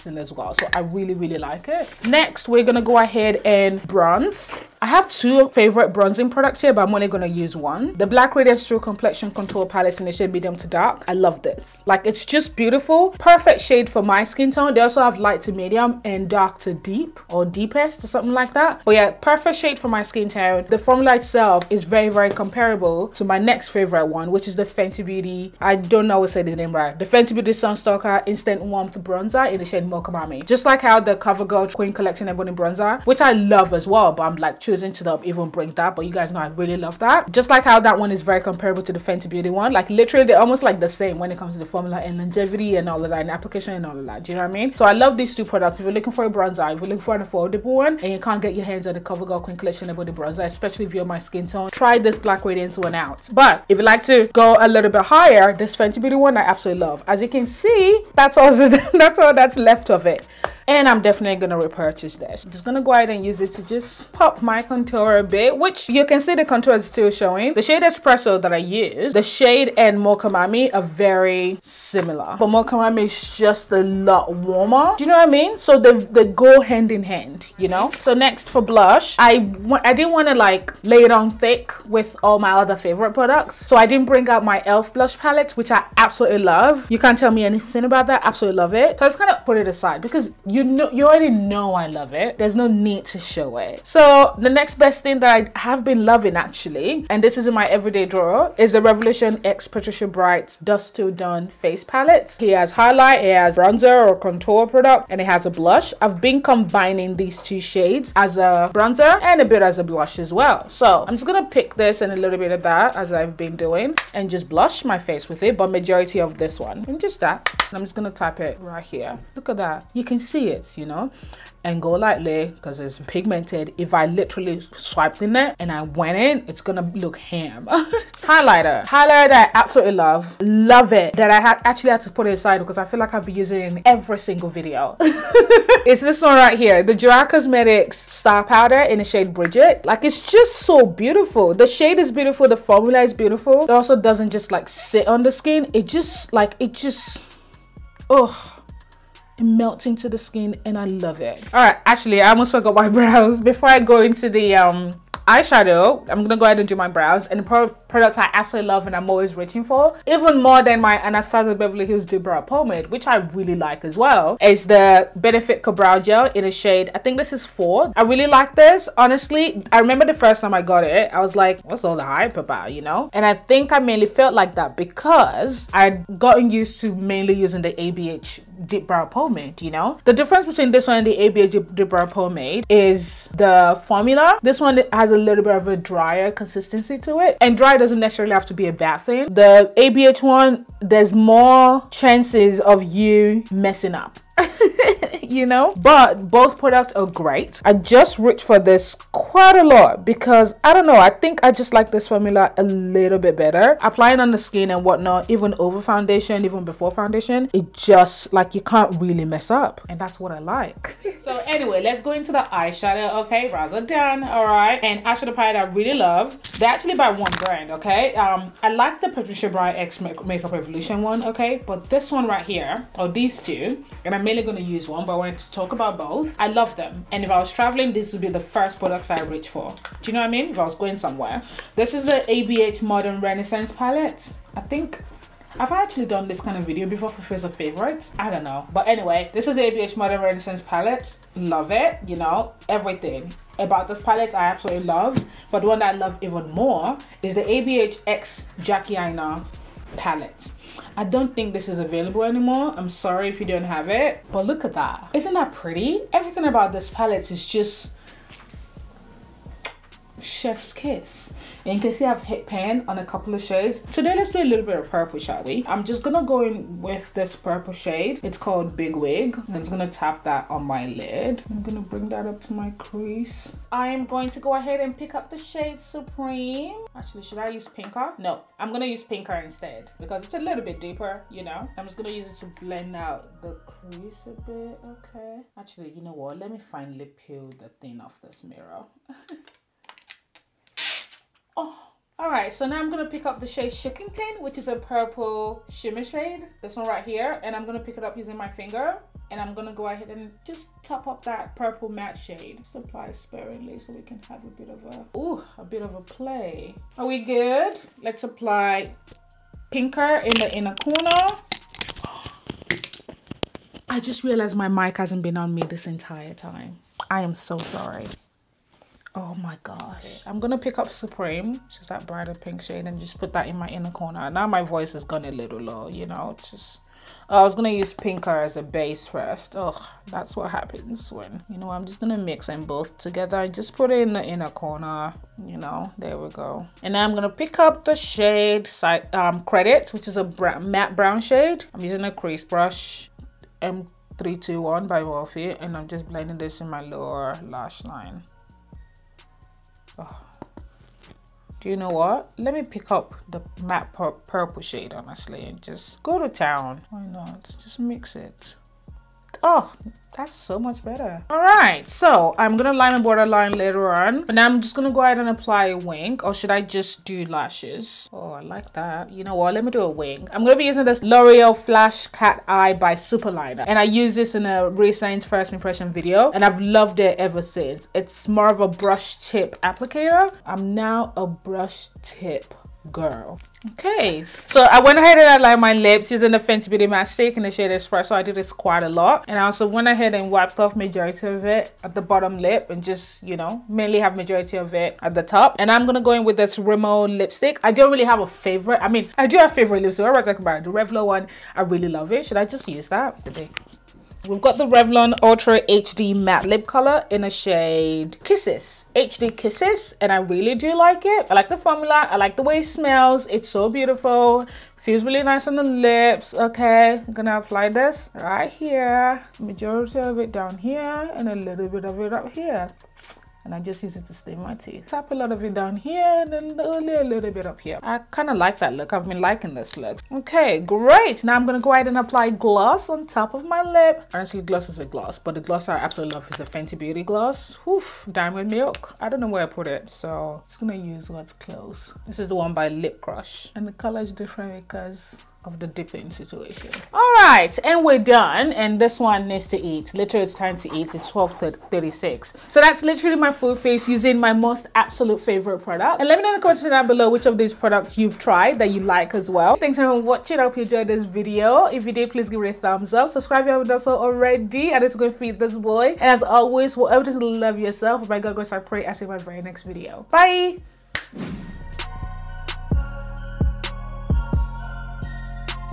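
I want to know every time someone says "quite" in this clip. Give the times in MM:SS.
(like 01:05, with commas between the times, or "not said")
03:19, 06:28.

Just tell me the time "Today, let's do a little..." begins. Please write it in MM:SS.
04:23.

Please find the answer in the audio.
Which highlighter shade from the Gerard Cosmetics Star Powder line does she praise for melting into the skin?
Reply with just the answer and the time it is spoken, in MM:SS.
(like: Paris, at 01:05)
Brigitte, at 02:19.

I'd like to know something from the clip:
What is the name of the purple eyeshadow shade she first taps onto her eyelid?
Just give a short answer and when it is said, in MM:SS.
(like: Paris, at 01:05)
Big Wig, at 04:28.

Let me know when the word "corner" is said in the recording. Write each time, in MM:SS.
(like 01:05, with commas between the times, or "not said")
05:10, 05:23, 05:34.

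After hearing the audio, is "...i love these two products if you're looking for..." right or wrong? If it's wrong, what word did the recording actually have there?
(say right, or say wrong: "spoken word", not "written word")
right.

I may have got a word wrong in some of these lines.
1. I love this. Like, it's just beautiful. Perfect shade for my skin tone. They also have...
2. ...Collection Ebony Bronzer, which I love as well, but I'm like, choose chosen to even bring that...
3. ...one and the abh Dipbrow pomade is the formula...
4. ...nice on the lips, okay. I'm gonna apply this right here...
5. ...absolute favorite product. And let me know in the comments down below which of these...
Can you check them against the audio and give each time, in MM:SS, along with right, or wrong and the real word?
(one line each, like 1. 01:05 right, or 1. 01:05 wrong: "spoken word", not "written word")
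1. 00:11 right
2. 00:31 right
3. 03:00 right
4. 06:55 right
5. 07:34 right.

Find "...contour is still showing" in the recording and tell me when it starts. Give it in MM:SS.
01:06.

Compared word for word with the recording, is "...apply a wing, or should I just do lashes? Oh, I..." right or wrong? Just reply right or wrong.
right.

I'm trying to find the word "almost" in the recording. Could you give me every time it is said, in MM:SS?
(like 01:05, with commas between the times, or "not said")
00:40, 02:32.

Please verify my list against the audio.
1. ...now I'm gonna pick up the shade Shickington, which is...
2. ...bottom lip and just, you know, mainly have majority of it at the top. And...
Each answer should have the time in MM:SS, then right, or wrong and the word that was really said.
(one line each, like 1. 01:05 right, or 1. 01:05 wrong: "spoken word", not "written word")
1. 04:52 right
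2. 06:32 right.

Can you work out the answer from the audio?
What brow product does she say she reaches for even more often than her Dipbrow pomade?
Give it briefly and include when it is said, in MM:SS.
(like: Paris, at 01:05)
Benefit Ka-Brow gel, at 02:45.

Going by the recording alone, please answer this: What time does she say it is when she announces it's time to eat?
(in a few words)
12:36.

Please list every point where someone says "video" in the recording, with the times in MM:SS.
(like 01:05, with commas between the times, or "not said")
02:14, 03:56, 06:15, 07:41, 07:49.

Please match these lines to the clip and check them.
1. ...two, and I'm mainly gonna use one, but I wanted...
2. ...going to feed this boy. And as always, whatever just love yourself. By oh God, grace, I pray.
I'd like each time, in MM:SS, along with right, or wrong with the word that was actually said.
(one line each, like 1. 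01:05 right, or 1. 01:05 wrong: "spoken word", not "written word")
1. 03:43 right
2. 07:44 right.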